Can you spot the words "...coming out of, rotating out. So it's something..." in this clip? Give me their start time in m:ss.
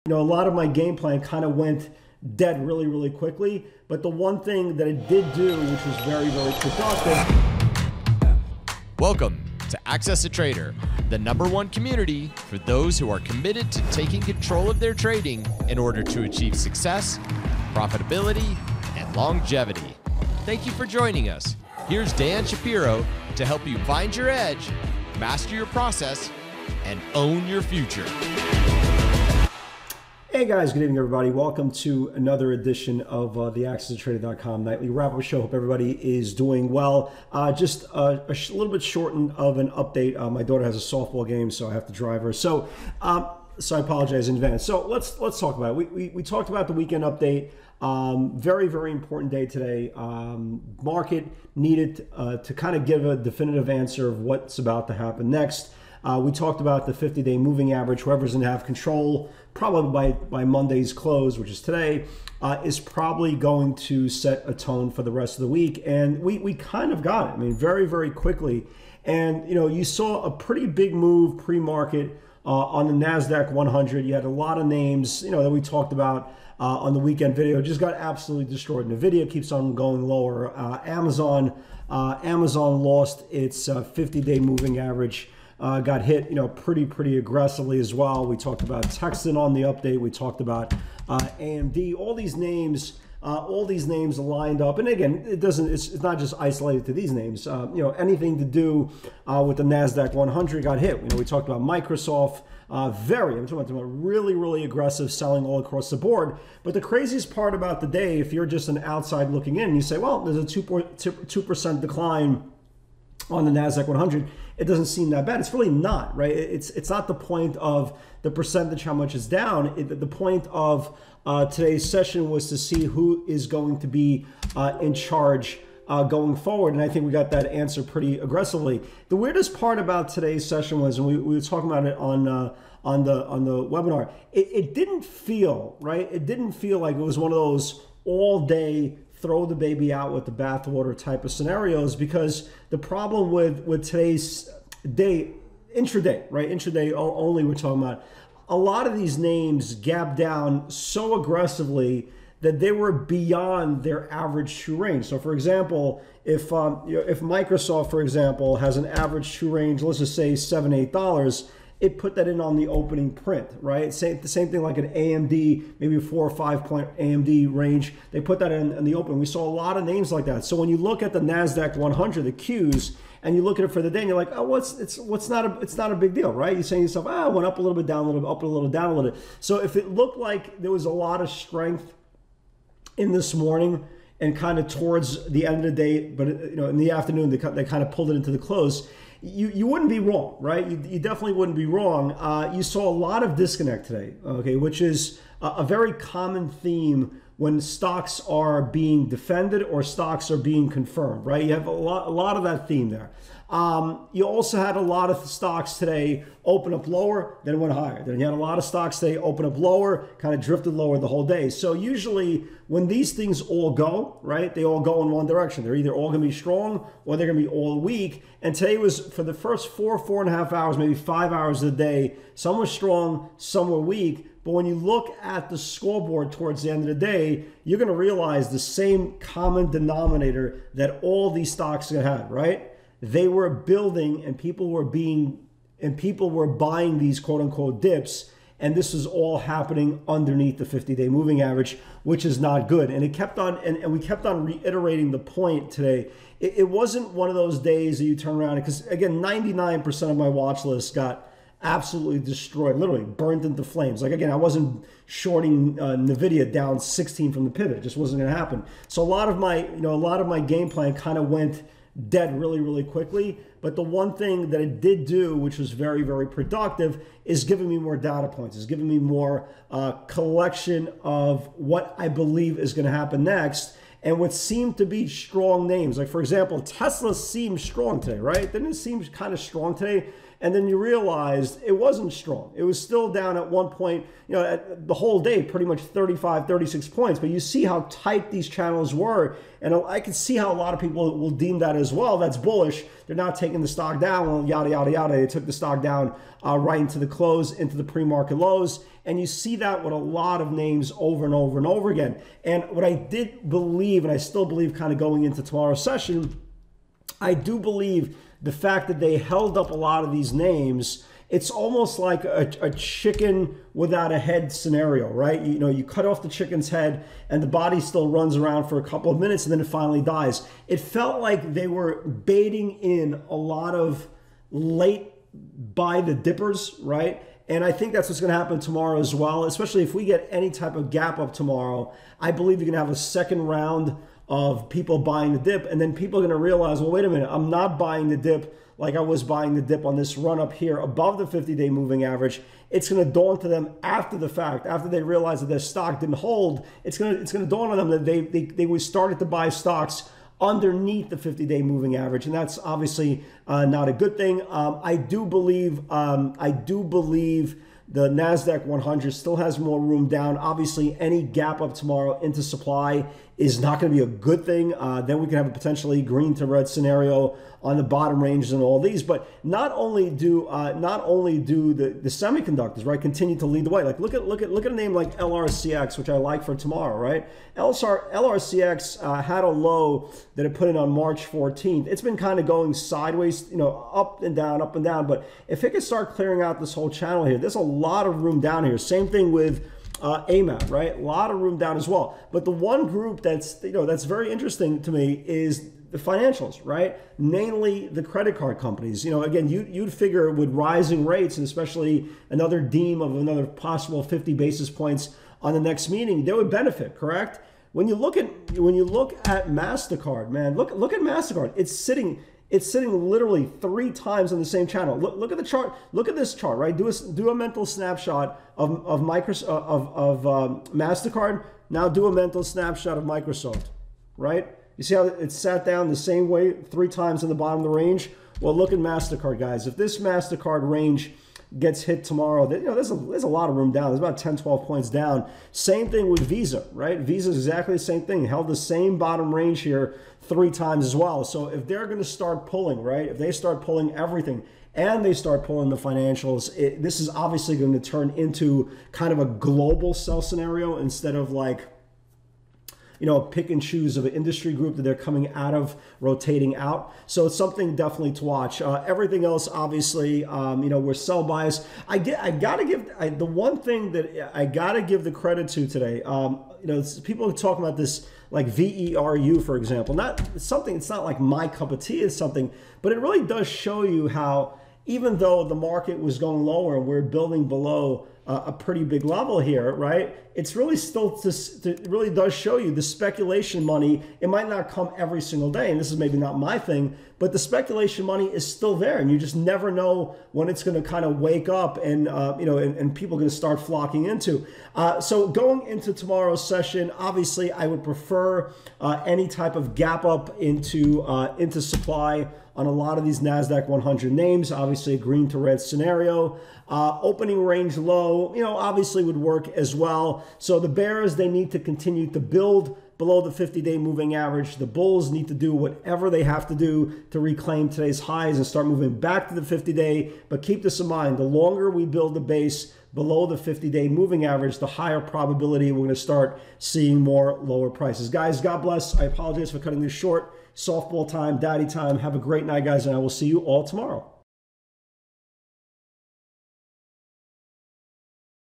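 7:34.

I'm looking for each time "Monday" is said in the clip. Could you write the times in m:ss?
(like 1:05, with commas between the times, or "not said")
1:00.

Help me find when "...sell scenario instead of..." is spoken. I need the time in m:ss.
7:29.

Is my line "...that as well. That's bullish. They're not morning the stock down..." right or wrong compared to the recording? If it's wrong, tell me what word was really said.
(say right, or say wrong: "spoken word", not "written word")
wrong: "taking", not "morning".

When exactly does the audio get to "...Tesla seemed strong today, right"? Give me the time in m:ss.
4:36.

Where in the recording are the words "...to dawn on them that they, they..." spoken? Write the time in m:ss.
5:47.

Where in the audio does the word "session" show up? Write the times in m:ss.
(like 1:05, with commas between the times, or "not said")
2:01, 2:10, 5:05, 8:16.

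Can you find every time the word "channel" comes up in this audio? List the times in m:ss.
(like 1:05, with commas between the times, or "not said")
4:48, 6:26, 6:54.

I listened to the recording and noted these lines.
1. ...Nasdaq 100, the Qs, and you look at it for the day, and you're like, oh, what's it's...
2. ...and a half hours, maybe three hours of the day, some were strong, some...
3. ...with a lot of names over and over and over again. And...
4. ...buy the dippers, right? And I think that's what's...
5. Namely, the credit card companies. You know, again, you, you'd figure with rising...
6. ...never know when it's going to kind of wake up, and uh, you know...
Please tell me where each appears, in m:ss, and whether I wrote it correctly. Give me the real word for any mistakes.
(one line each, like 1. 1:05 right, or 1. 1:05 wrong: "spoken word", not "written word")
1. 2:51 right
2. 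3:40 wrong: "five", not "three"
3. 4:59 right
4. 5:25 right
5. 6:37 right
6. 8:09 right.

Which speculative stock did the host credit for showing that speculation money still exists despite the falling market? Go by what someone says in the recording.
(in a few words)
VERU.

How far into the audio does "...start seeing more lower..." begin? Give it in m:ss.
8:45.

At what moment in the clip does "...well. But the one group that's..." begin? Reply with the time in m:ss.
6:31.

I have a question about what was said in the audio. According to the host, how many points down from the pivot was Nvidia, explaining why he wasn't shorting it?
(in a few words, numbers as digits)
16.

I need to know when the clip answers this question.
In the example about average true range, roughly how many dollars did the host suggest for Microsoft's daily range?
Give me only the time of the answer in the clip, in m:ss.
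2:40.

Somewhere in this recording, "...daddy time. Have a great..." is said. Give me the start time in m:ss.
8:51.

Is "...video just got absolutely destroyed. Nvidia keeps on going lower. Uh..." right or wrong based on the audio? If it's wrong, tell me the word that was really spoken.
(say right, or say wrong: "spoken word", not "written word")
right.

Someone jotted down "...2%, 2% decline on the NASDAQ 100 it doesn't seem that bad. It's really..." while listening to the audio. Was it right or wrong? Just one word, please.
right.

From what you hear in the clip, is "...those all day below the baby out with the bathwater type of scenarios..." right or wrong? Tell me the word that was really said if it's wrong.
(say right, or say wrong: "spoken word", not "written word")
wrong: "throw", not "below".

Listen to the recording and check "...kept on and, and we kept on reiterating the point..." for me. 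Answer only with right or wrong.
right.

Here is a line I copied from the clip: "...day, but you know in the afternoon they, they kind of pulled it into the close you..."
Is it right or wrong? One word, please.
right.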